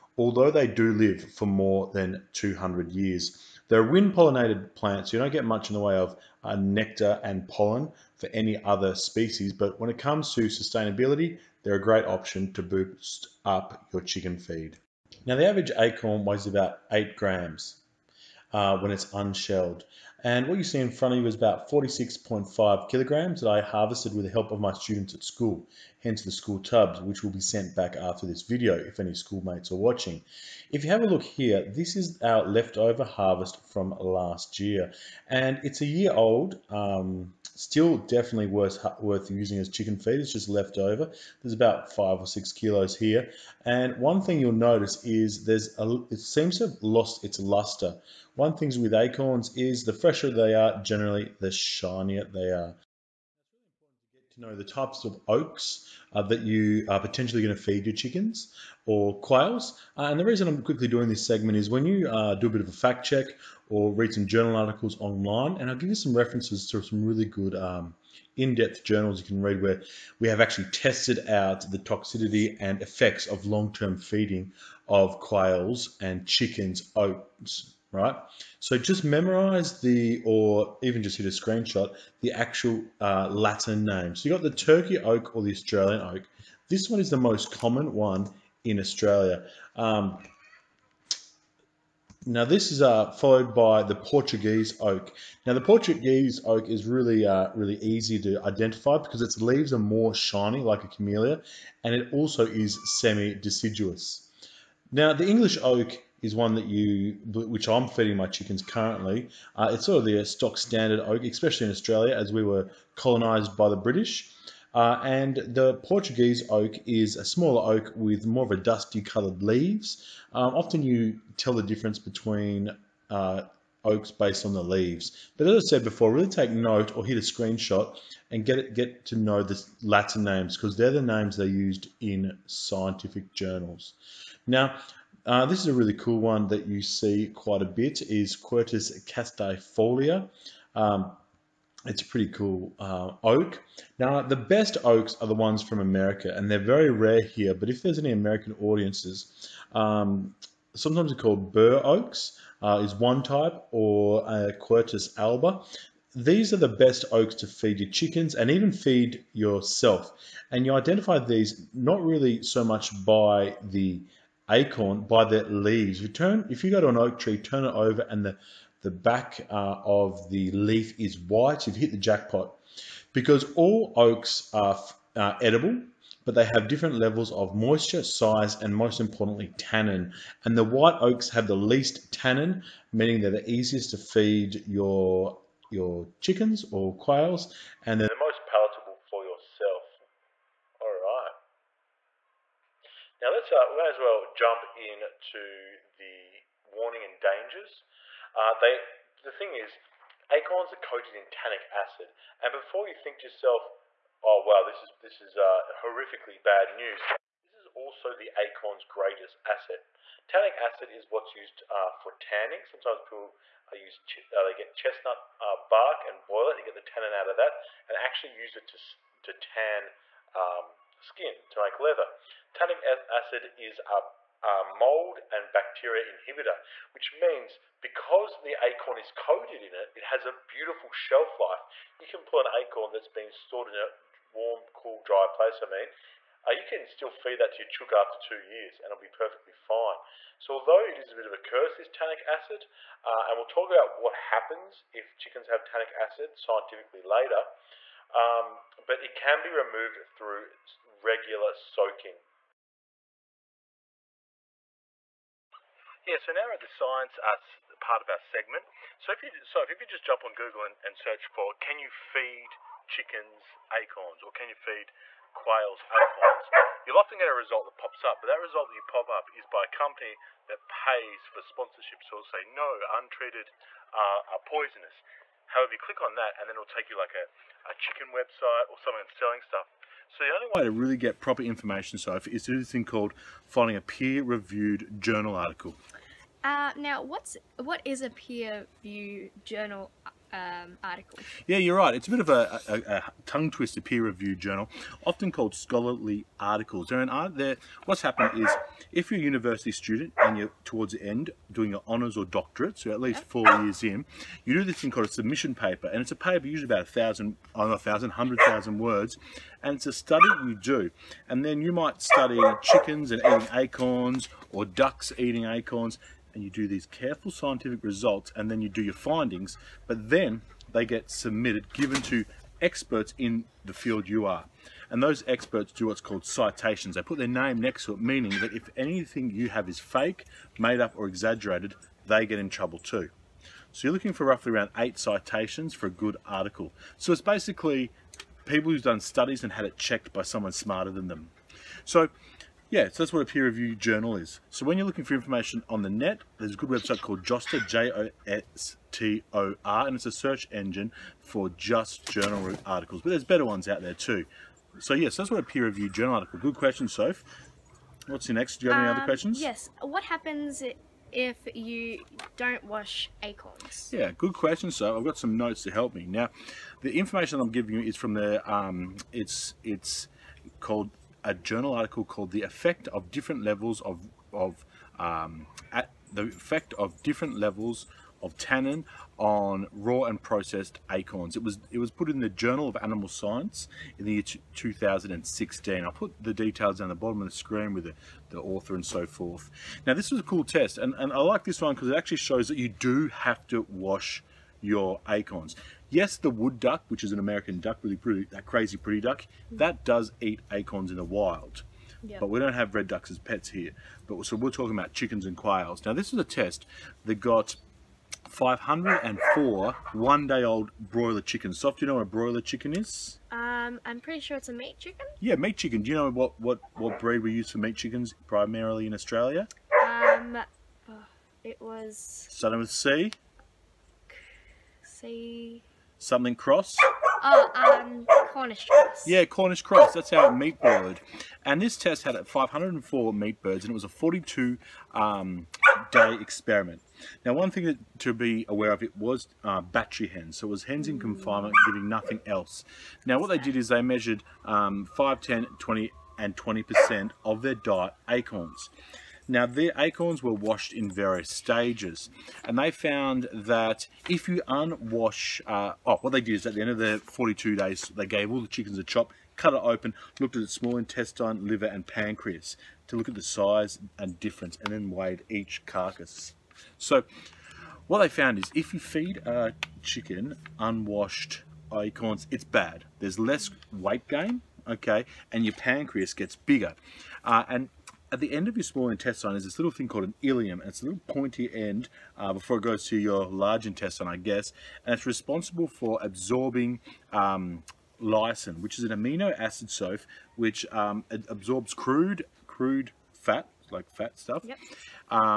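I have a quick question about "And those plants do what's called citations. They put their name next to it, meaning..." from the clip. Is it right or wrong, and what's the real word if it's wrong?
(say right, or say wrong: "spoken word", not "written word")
wrong: "experts", not "plants".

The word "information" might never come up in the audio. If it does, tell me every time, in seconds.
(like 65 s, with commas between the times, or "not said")
281 s, 345 s, 366 s.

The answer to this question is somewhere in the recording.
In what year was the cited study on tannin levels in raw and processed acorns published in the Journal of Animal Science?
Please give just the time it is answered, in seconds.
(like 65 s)
384 s.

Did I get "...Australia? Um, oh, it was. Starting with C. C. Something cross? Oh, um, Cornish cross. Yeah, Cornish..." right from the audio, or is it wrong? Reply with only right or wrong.
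right.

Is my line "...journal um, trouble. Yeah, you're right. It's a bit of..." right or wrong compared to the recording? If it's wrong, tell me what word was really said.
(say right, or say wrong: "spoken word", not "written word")
wrong: "article", not "trouble".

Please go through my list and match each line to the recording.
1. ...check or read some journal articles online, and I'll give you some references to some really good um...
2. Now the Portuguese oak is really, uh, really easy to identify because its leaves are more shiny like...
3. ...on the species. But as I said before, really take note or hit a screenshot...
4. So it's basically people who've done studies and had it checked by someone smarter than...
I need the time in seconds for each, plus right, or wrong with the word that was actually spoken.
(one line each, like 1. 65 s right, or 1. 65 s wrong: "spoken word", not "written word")
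1. 63 s right
2. 95 s right
3. 124 s wrong: "leaves", not "species"
4. 336 s right.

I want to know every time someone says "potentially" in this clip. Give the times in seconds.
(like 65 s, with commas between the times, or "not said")
56 s.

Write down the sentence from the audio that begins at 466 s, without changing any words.
So what they found is if you feed a chicken unwashed acorns, it's bad.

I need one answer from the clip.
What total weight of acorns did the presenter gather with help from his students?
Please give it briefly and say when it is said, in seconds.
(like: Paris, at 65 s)
46.5 kilograms, at 21 s.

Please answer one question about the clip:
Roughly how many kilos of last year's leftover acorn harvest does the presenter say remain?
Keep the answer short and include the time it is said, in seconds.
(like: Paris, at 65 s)
five or six kilos, at 41 s.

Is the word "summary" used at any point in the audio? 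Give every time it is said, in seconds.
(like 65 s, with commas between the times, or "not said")
not said.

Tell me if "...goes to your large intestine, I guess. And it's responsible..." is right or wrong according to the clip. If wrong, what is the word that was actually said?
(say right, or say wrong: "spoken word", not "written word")
right.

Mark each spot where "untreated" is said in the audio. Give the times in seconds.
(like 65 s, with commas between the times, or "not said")
272 s.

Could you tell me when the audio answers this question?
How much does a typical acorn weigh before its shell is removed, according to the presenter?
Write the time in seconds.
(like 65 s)
16 s.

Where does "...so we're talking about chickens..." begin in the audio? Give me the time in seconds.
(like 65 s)
404 s.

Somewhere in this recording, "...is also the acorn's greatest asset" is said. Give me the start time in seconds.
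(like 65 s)
207 s.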